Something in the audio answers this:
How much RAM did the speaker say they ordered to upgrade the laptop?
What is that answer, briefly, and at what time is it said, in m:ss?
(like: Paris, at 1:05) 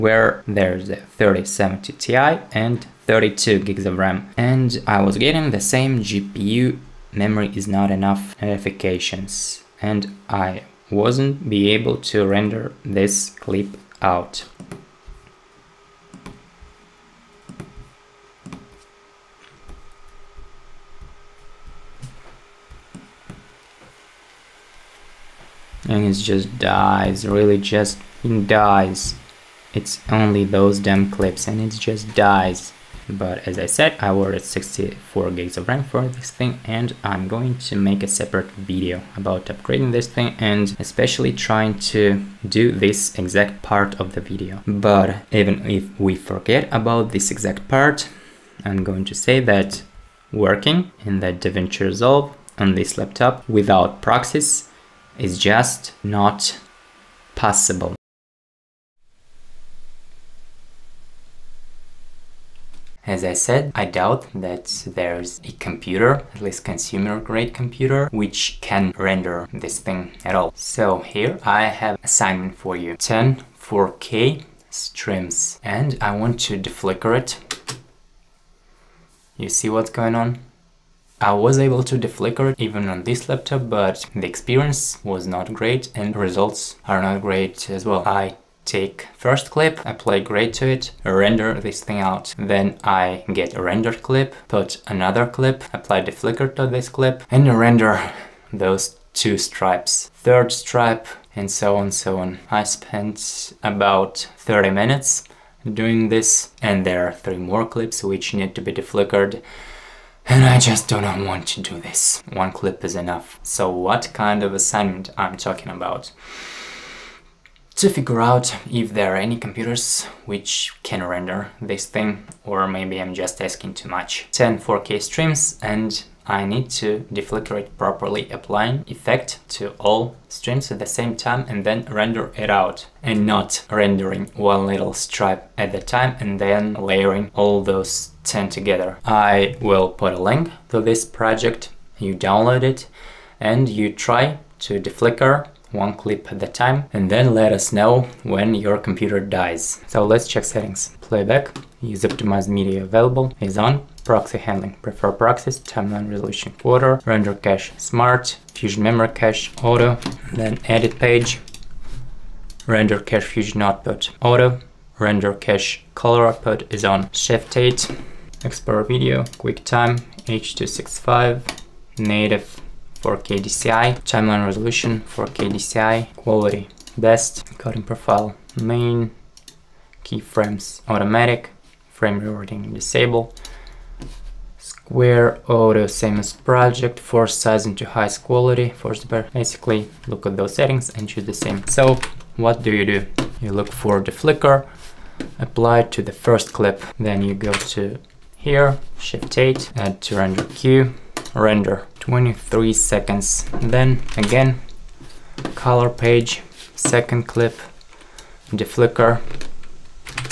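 64 GB, at 0:34.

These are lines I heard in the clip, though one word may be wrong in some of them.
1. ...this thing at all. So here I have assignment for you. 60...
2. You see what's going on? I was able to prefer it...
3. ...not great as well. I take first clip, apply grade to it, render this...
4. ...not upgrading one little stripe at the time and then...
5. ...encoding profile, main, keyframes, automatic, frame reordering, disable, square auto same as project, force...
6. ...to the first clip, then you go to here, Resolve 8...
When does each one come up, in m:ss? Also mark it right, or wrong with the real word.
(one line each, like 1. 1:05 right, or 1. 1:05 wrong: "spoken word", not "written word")
1. 1:09 wrong: "10", not "60"
2. 1:19 wrong: "deflicker", not "prefer"
3. 1:27 right
4. 2:13 wrong: "rendering", not "upgrading"
5. 2:57 right
6. 3:15 wrong: "Shift", not "Resolve".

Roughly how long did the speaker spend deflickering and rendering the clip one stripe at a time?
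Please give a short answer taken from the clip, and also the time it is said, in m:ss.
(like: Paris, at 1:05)
30 minutes, at 1:44.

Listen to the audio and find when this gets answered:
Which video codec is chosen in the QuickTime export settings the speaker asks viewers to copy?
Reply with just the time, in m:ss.
2:50.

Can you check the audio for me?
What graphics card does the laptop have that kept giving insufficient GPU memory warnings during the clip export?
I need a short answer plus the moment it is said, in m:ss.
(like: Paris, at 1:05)
3070 Ti, at 0:00.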